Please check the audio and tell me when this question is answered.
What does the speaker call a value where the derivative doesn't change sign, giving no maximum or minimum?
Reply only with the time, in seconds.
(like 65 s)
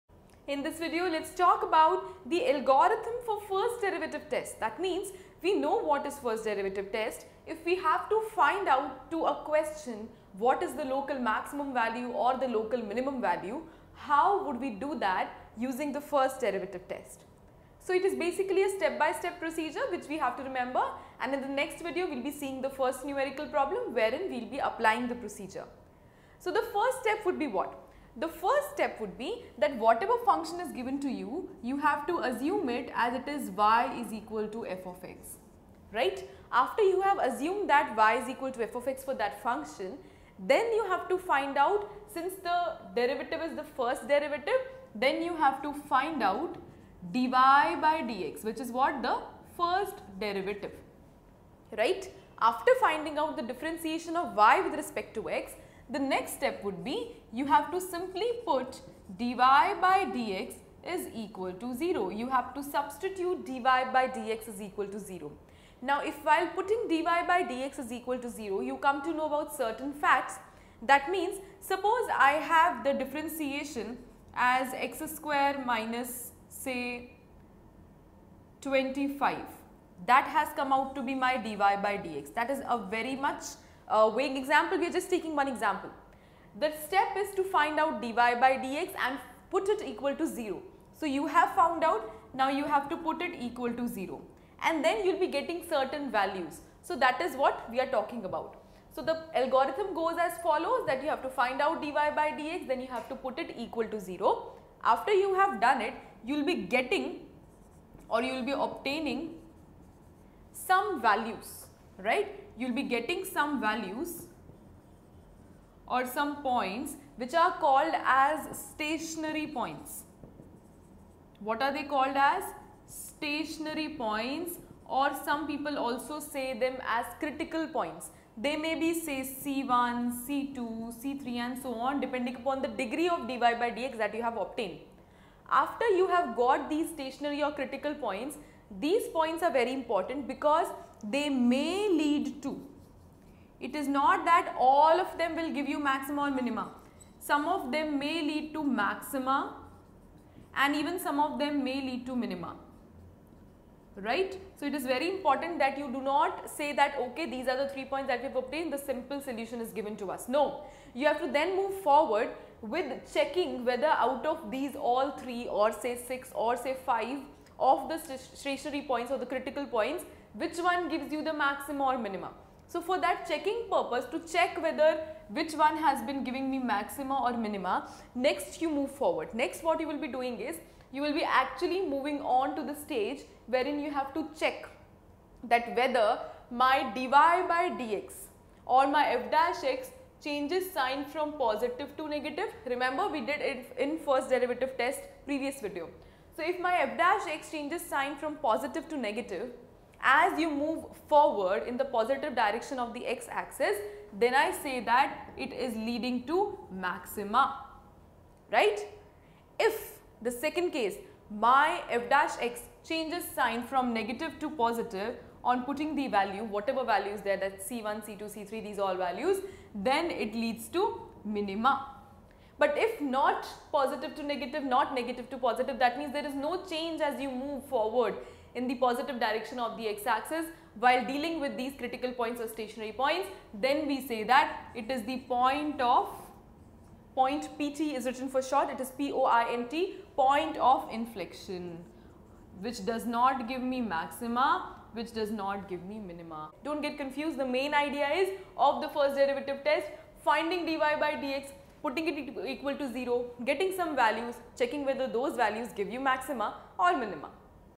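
240 s.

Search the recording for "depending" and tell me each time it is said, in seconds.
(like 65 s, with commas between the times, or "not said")
131 s.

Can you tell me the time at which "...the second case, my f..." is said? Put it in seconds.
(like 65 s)
210 s.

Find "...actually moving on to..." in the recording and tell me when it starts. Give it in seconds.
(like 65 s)
181 s.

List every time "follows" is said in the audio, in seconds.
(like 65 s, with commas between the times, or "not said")
100 s.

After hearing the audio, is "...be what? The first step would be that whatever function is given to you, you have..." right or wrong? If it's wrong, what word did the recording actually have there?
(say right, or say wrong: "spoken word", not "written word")
right.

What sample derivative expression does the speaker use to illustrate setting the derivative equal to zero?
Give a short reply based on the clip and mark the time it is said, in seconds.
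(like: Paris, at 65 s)
x^2 - 25, at 74 s.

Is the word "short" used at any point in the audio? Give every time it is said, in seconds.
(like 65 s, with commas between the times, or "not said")
238 s.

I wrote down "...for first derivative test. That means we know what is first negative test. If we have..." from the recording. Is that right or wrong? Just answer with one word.
wrong.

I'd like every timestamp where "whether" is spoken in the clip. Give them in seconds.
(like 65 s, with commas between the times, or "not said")
163 s, 174 s, 185 s, 254 s.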